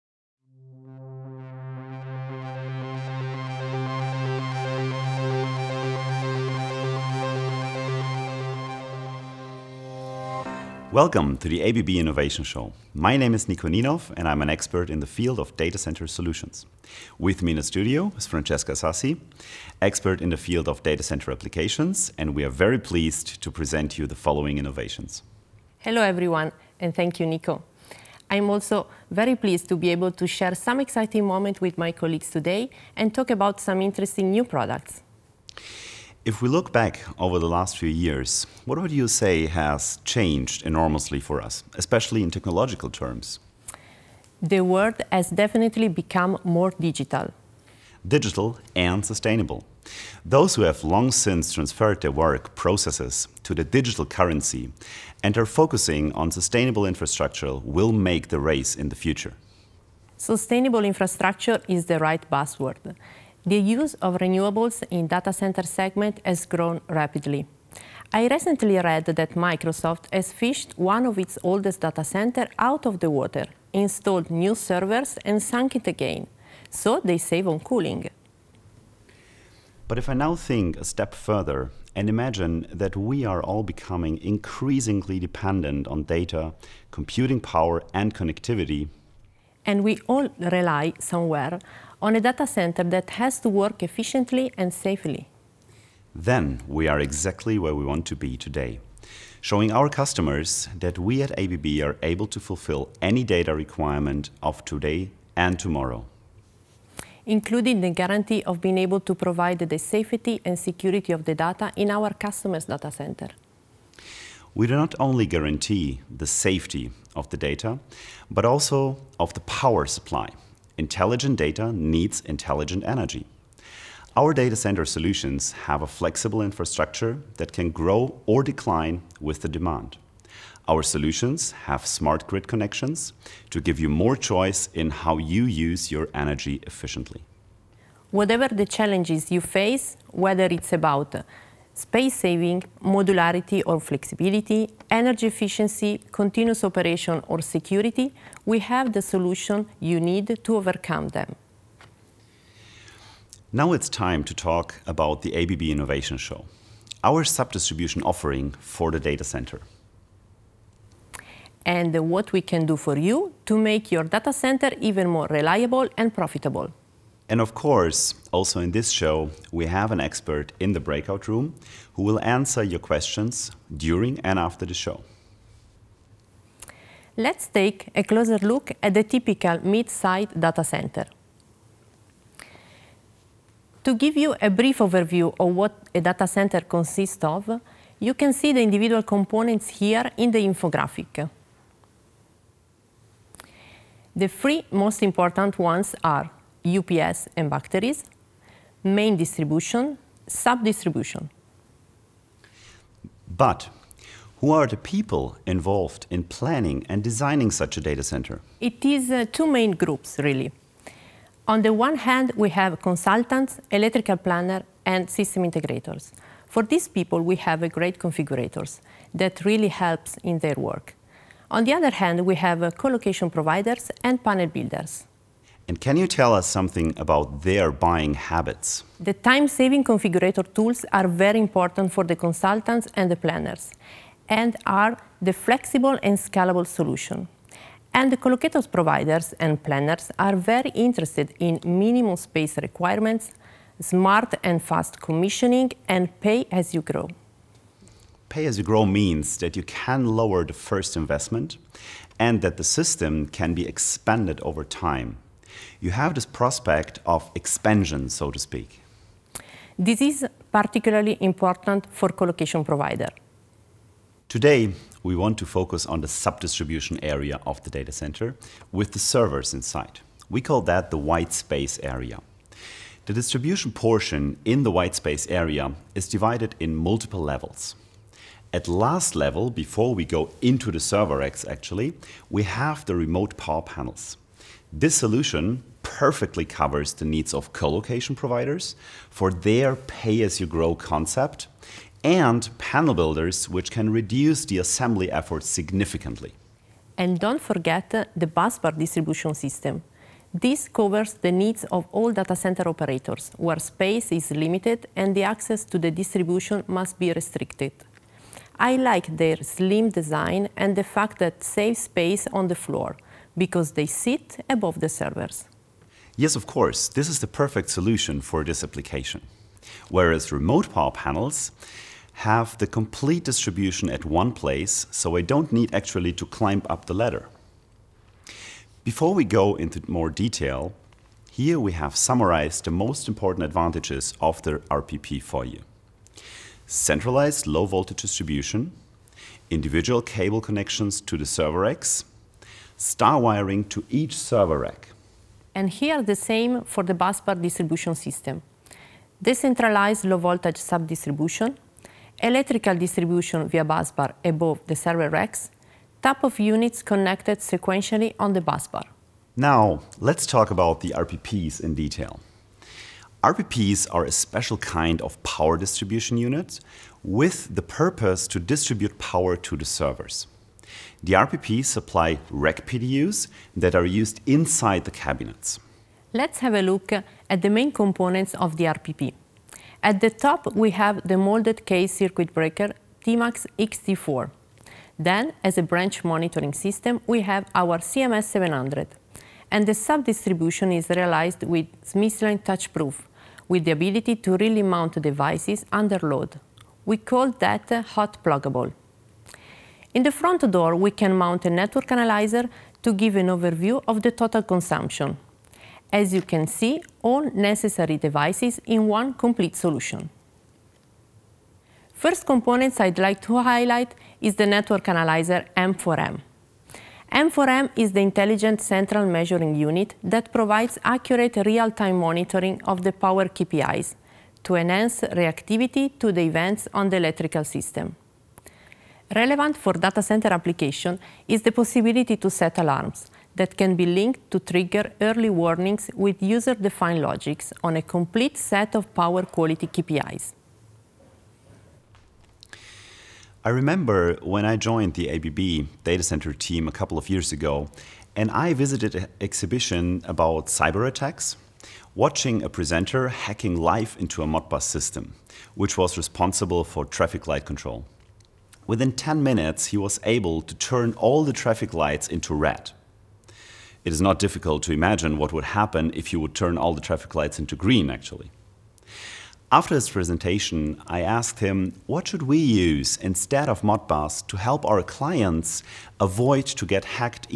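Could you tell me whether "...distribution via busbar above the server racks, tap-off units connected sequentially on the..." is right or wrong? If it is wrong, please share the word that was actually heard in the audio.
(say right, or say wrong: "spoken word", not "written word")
right.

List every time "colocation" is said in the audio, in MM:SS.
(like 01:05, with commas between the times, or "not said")
04:22, 04:47.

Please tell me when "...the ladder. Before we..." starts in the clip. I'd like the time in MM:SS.
05:26.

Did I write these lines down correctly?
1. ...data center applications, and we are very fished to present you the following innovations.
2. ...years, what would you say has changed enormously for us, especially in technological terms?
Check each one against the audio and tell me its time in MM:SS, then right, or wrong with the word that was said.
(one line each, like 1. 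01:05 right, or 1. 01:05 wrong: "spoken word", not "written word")
1. 00:20 wrong: "pleased", not "fished"
2. 00:37 right.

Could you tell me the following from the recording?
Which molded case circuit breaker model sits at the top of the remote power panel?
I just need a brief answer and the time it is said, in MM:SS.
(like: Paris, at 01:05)
Tmax XT4, at 06:23.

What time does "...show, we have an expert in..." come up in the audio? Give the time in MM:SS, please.
02:48.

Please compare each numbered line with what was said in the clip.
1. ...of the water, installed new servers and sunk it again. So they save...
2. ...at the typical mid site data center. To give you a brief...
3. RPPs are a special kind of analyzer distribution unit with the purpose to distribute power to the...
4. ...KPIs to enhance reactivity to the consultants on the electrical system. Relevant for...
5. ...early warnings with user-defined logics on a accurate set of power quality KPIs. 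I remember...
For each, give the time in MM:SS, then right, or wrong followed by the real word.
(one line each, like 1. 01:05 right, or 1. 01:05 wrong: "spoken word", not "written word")
1. 01:12 right
2. 02:58 right
3. 06:03 wrong: "power", not "analyzer"
4. 07:03 wrong: "events", not "consultants"
5. 07:15 wrong: "complete", not "accurate".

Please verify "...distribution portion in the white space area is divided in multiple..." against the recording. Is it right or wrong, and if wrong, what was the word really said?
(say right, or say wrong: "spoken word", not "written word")
right.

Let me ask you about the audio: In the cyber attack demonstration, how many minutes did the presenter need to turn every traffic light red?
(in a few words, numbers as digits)
10.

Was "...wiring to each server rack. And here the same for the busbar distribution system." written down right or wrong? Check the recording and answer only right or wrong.
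right.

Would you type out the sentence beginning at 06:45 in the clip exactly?
As you can see, all necessary devices in one complete solution.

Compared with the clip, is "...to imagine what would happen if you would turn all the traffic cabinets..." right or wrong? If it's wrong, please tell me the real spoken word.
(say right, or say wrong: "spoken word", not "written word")
wrong: "lights", not "cabinets".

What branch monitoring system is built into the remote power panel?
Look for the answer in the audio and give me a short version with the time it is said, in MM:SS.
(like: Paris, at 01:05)
CMS 700, at 06:27.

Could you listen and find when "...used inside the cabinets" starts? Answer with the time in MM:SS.
06:13.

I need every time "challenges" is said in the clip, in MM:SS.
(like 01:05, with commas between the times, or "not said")
02:18.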